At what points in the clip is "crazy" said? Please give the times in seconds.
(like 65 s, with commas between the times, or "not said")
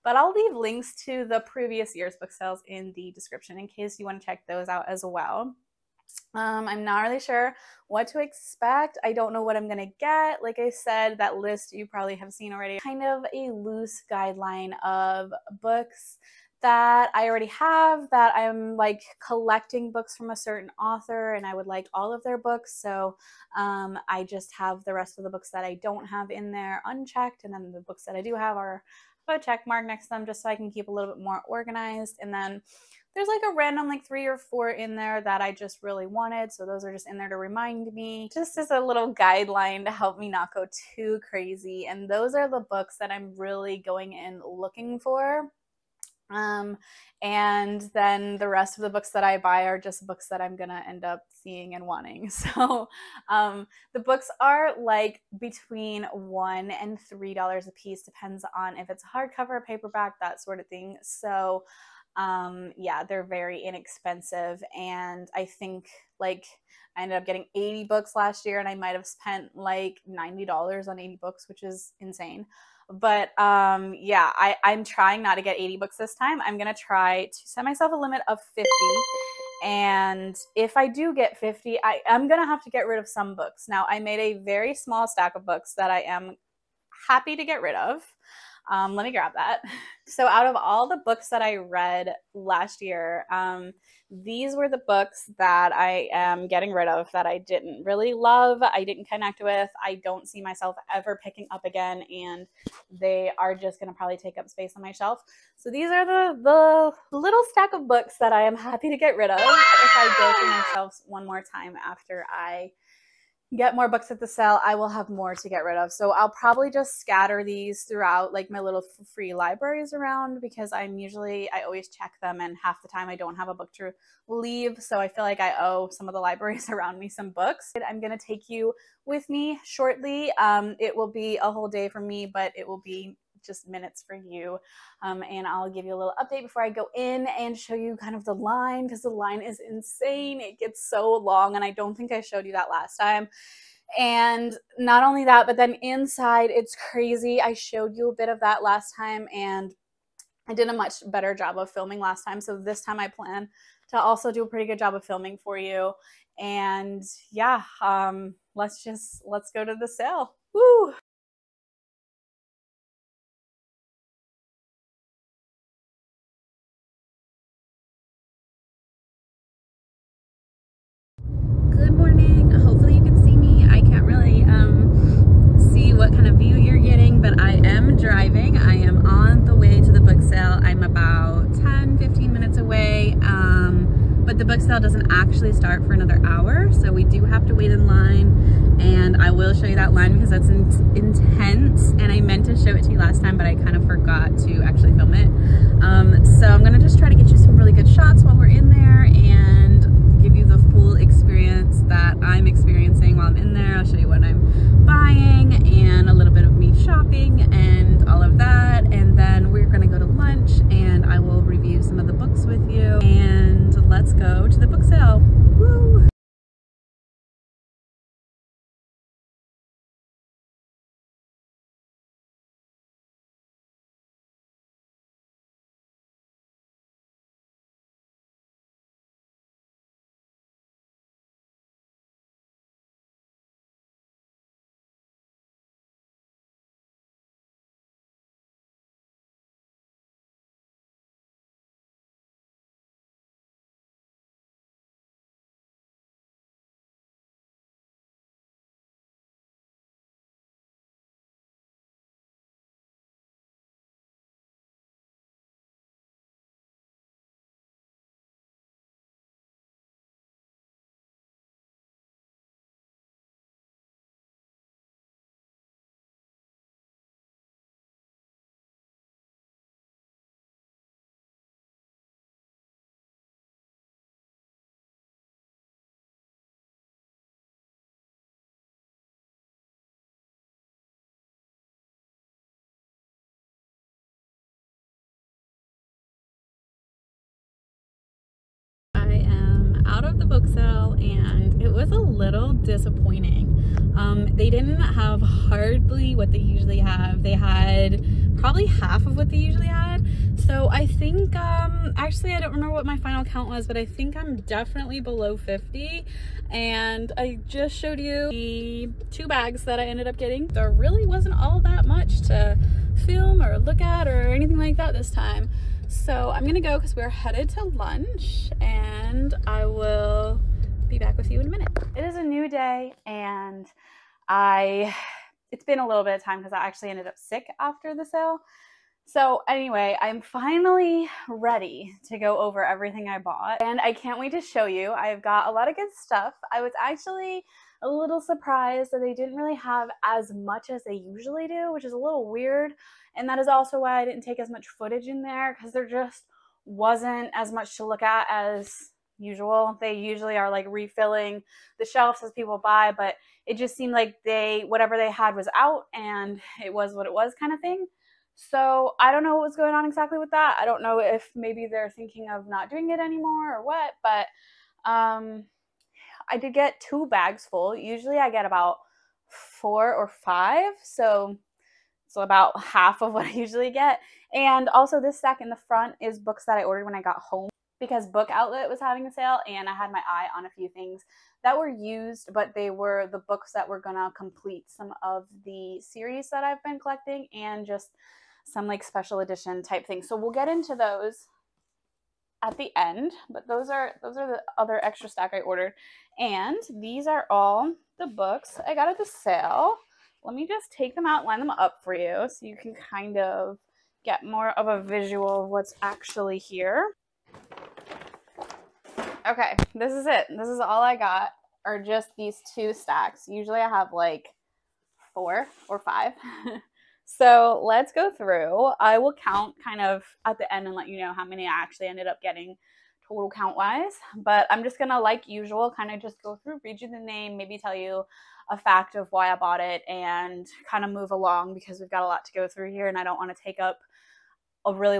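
41 s, 146 s.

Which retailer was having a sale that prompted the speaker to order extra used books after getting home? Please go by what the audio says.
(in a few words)
Book Outlet.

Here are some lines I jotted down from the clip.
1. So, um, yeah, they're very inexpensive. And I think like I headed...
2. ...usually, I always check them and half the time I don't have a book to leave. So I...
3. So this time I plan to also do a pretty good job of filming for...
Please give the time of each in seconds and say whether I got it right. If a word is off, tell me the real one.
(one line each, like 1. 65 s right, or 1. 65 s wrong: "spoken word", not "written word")
1. 61 s wrong: "ended", not "headed"
2. 120 s right
3. 152 s right.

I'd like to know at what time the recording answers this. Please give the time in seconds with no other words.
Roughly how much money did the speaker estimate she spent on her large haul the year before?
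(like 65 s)
70 s.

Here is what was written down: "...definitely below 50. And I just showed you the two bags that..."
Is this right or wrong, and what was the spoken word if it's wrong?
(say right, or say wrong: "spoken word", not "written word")
right.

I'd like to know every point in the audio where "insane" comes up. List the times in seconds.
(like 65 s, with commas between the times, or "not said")
71 s, 139 s.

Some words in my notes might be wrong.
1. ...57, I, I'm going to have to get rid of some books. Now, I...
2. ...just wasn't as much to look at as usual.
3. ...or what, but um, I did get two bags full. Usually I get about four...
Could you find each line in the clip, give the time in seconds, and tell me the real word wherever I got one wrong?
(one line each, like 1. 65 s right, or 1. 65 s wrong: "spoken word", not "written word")
1. 81 s wrong: "50", not "57"
2. 345 s right
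3. 363 s right.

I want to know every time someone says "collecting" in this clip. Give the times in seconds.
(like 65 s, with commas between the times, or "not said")
19 s, 386 s.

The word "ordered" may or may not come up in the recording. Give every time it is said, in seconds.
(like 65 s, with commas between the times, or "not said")
376 s, 395 s.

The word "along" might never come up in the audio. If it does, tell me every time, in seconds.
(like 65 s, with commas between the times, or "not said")
431 s.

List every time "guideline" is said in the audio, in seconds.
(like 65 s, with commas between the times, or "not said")
14 s, 39 s.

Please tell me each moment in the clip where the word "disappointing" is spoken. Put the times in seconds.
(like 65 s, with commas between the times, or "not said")
292 s.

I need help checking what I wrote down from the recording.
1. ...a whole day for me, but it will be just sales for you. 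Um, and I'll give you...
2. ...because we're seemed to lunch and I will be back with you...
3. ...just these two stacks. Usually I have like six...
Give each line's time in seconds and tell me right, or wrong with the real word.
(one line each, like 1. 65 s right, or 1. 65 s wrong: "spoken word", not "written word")
1. 131 s wrong: "minutes", not "sales"
2. 316 s wrong: "headed", not "seemed"
3. 411 s wrong: "four", not "six".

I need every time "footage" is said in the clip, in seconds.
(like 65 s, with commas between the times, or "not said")
344 s.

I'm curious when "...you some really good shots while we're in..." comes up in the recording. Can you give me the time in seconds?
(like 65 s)
197 s.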